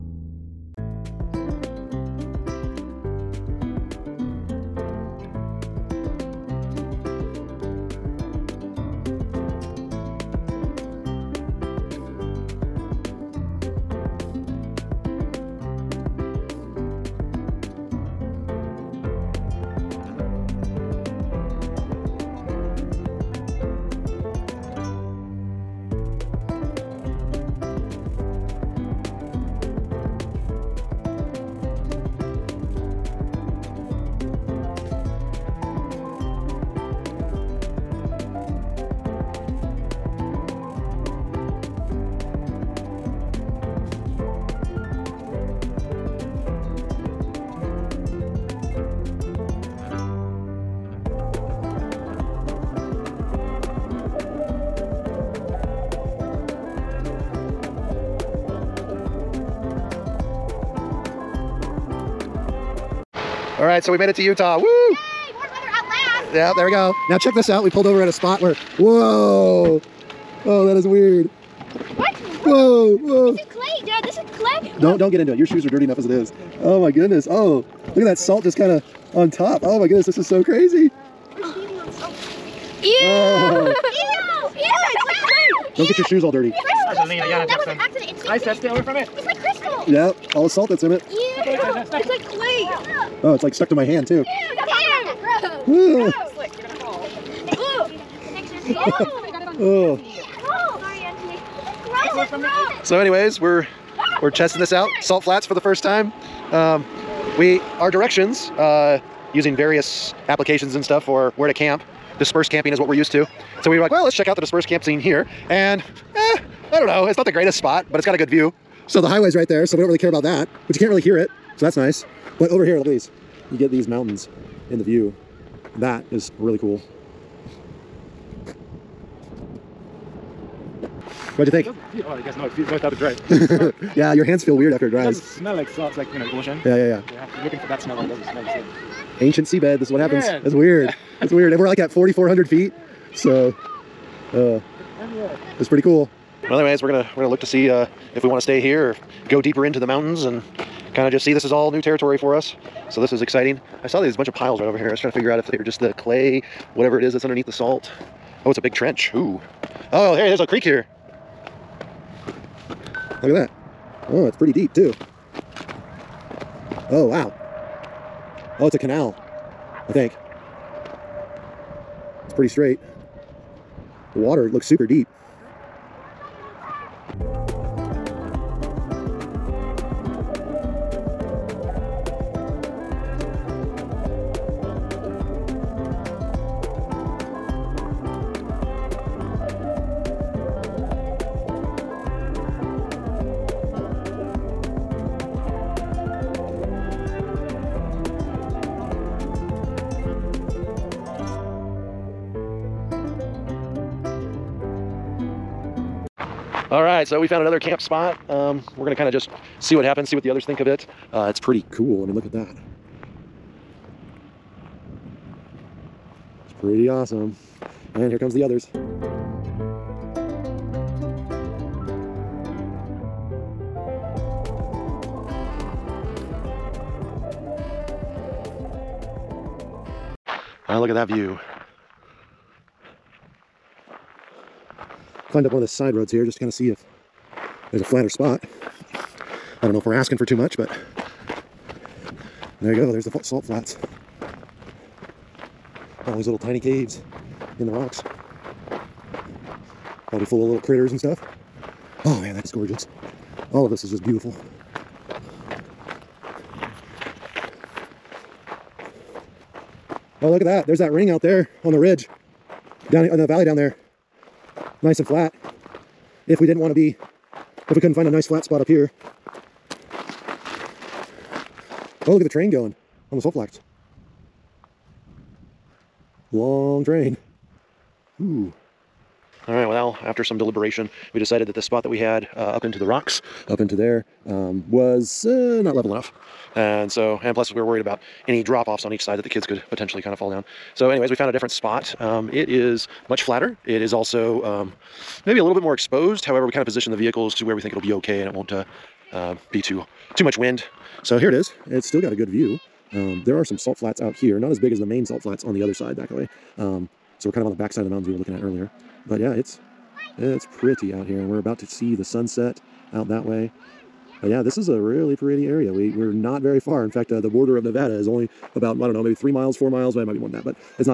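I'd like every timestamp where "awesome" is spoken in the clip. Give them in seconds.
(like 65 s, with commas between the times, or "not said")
216 s.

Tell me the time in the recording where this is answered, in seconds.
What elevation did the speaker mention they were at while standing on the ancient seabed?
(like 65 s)
141 s.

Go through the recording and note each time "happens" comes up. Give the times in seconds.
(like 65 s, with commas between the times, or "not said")
139 s, 209 s.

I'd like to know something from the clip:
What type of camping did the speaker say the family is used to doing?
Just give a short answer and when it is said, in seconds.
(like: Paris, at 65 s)
Dispersed camping, at 112 s.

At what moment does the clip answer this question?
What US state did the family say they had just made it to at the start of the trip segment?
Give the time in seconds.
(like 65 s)
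64 s.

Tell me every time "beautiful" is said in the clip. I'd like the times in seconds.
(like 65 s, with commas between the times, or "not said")
254 s.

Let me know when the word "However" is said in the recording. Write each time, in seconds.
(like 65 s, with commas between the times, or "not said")
296 s.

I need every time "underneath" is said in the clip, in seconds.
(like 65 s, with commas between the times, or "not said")
157 s.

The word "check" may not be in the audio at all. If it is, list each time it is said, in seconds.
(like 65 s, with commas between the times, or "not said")
67 s, 114 s.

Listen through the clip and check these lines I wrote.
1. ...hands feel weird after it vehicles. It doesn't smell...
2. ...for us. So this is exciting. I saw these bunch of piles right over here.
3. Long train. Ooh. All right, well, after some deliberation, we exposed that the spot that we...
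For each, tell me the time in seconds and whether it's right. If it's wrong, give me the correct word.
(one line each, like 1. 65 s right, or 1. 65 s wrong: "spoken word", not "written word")
1. 134 s wrong: "dries", not "vehicles"
2. 152 s right
3. 276 s wrong: "decided", not "exposed".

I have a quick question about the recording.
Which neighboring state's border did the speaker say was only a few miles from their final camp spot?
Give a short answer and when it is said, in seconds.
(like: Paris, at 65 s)
Nevada, at 317 s.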